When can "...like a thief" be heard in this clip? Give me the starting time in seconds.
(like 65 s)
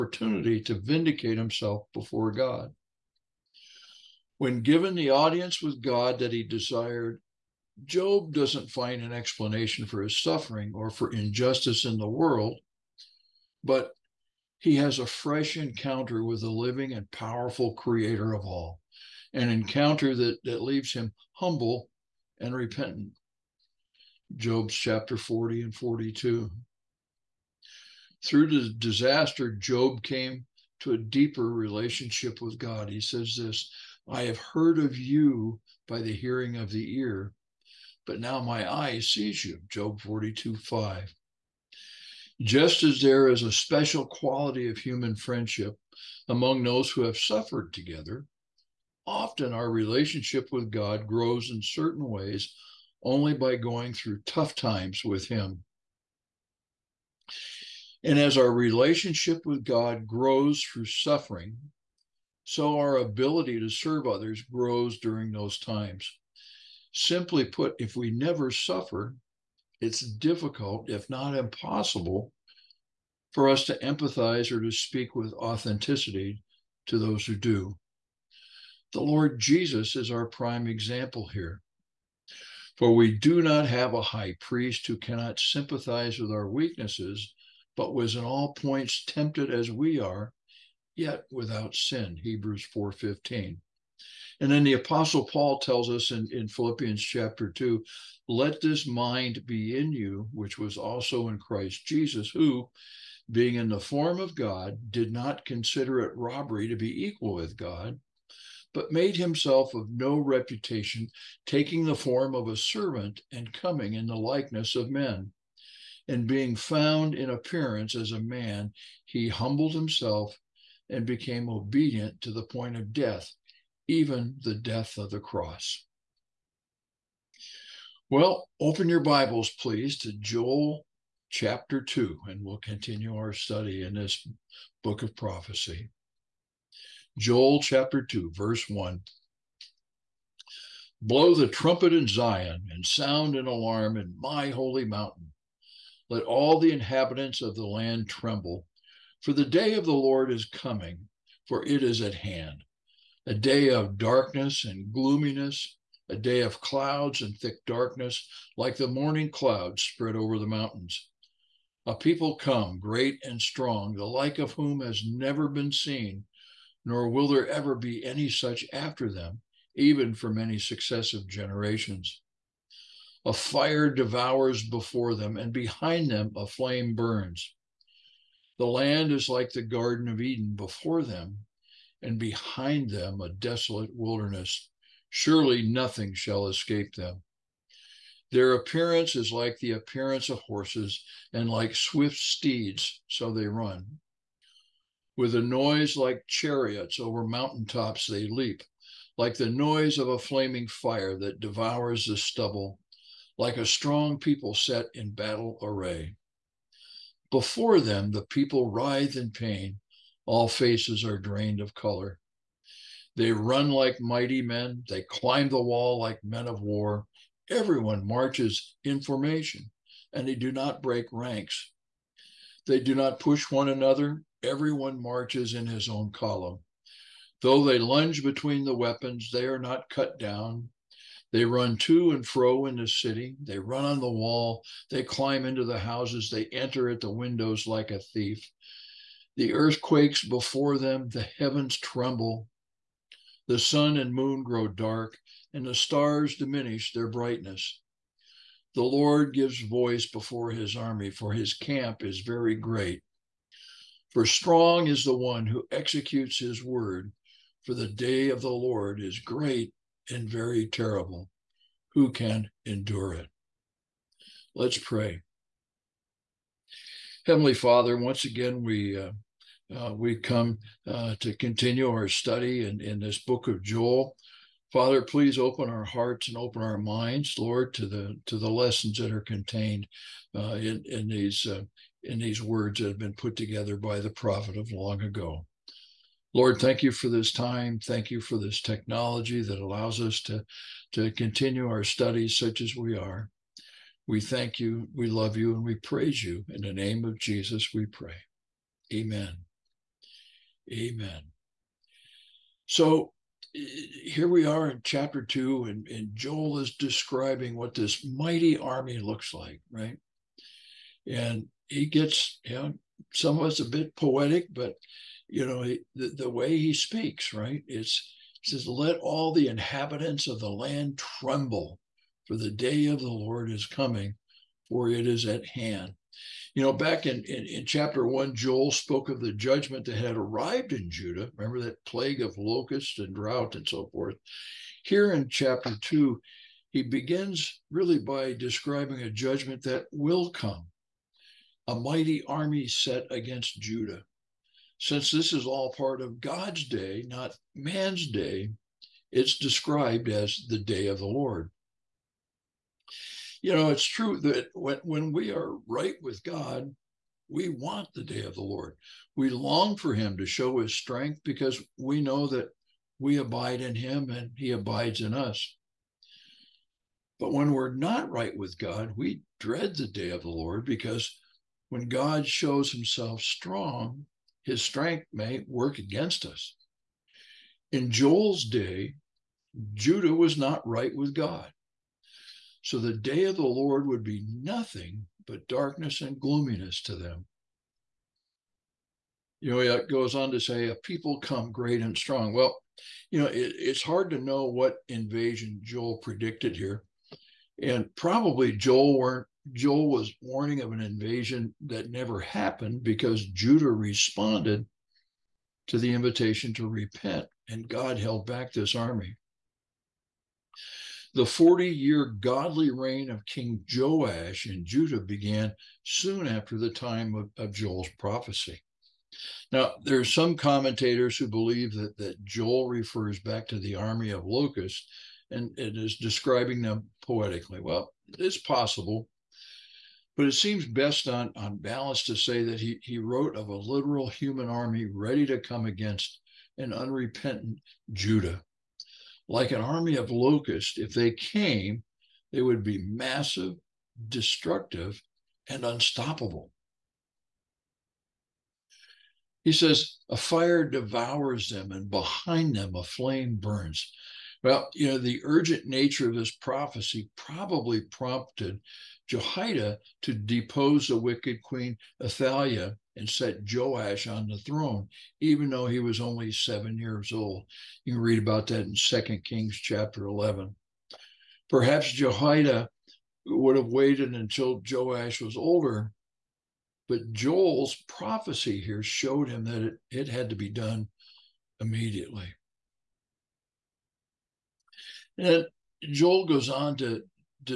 237 s.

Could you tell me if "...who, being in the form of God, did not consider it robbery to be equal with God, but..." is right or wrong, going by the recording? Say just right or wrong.
right.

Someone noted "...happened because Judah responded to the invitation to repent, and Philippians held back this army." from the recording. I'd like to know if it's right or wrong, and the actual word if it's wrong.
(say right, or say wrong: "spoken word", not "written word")
wrong: "God", not "Philippians".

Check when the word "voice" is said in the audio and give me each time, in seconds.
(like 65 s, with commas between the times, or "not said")
249 s.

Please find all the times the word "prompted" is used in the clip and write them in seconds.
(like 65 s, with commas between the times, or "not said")
457 s.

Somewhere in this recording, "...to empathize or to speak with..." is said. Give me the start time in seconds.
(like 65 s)
73 s.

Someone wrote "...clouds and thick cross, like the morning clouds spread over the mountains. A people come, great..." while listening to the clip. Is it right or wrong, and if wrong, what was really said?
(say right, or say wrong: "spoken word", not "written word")
wrong: "darkness", not "cross".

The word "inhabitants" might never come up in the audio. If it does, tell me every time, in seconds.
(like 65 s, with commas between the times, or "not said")
146 s, 319 s.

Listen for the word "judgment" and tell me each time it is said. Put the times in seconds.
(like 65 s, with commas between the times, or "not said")
329 s, 339 s.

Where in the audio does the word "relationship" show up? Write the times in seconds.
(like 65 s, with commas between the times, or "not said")
31 s, 49 s, 58 s.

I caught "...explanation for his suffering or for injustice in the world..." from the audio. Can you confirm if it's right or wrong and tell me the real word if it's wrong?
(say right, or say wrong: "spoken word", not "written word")
right.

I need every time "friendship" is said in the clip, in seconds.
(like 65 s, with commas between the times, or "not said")
45 s.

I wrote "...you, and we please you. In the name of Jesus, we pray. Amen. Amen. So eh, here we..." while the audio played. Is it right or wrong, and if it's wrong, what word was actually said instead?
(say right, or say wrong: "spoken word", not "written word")
wrong: "praise", not "please".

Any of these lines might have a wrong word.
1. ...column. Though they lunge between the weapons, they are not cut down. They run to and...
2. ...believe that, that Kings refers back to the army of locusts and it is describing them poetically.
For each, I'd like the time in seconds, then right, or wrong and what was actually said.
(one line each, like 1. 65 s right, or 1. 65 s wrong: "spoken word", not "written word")
1. 226 s right
2. 421 s wrong: "Joel", not "Kings".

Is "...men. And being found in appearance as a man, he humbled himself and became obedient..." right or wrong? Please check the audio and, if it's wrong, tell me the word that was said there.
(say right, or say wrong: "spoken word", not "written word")
right.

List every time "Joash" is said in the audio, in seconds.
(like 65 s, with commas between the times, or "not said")
413 s, 463 s, 474 s.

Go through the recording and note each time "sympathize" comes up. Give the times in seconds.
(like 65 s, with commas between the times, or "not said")
85 s.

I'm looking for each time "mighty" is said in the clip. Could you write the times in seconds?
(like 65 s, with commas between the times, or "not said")
214 s, 308 s, 341 s.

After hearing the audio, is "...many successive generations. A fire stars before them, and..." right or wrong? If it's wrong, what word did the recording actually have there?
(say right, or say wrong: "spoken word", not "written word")
wrong: "devours", not "stars".